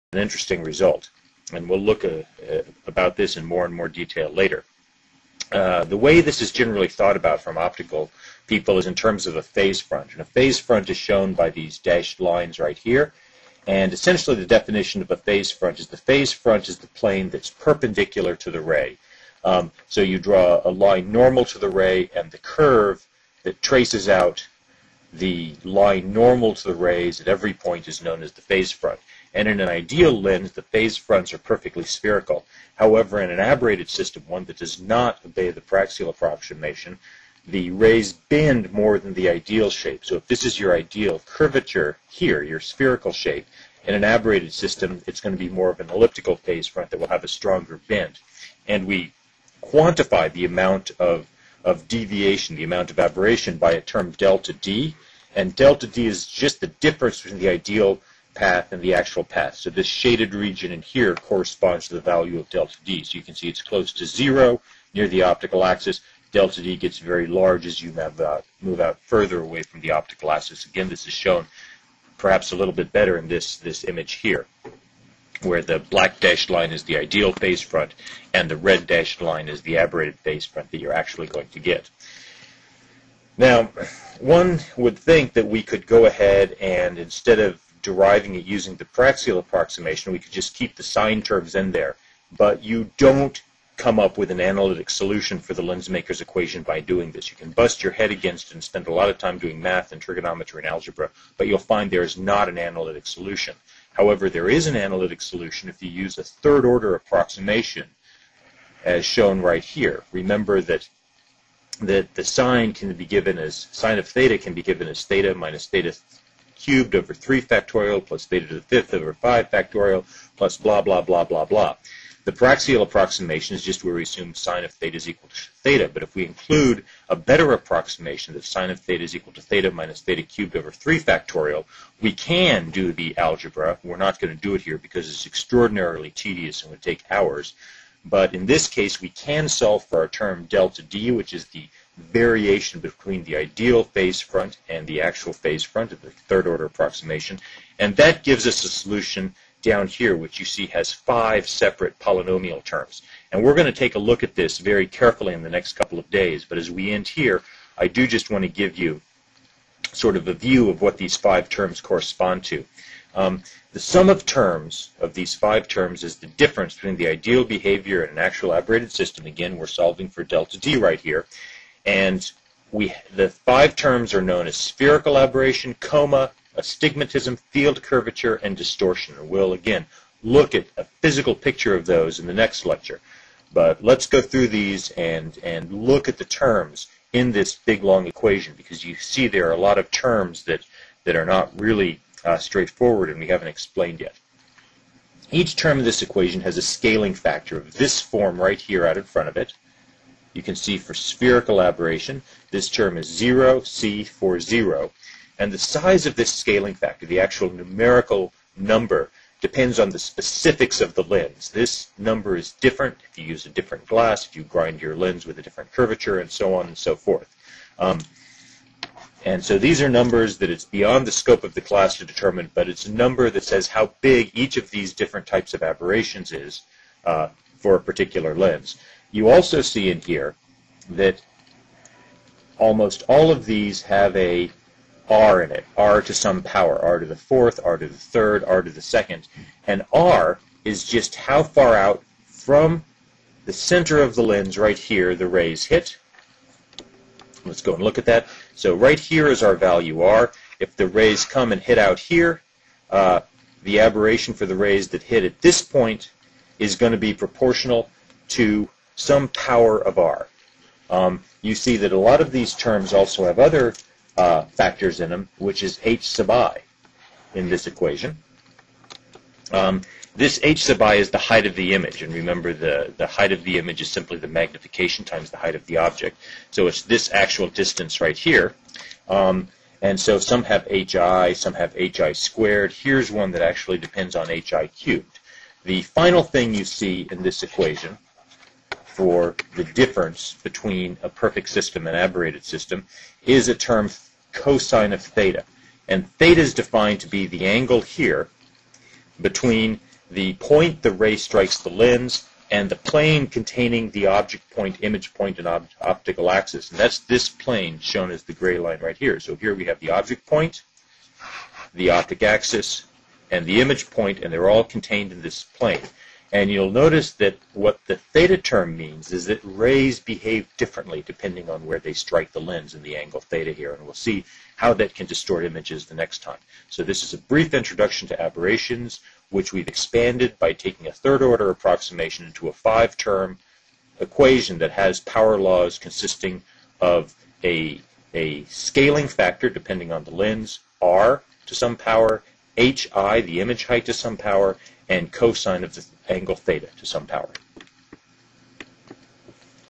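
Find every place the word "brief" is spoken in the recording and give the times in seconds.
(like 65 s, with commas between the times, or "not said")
327 s.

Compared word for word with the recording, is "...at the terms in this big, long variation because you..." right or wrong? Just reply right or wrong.
wrong.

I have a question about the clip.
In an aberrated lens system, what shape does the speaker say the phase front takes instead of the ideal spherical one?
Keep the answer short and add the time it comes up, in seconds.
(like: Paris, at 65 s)
Elliptical, at 45 s.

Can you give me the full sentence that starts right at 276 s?
So it's this actual distance right here.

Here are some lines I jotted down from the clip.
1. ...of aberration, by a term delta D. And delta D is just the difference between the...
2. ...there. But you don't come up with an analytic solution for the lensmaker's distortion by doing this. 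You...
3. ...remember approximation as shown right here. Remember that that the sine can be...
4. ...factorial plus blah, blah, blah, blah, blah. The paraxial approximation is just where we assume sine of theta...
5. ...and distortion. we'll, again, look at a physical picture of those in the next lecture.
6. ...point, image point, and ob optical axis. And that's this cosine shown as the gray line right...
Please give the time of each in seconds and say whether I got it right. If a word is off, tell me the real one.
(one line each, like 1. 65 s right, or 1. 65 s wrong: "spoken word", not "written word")
1. 52 s right
2. 91 s wrong: "equation", not "distortion"
3. 106 s wrong: "order", not "remember"
4. 119 s right
5. 178 s right
6. 304 s wrong: "plane", not "cosine".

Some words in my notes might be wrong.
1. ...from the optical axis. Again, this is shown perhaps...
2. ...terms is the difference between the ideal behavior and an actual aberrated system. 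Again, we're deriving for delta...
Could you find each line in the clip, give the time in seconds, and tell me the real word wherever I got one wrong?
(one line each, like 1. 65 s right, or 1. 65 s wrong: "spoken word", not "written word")
1. 69 s right
2. 165 s wrong: "solving", not "deriving".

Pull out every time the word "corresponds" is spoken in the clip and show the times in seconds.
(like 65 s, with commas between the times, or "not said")
61 s, 161 s.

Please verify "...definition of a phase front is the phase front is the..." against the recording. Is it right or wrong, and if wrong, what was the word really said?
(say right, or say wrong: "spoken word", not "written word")
right.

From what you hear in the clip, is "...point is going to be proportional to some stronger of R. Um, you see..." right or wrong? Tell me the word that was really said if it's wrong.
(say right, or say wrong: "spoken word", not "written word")
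wrong: "power", not "stronger".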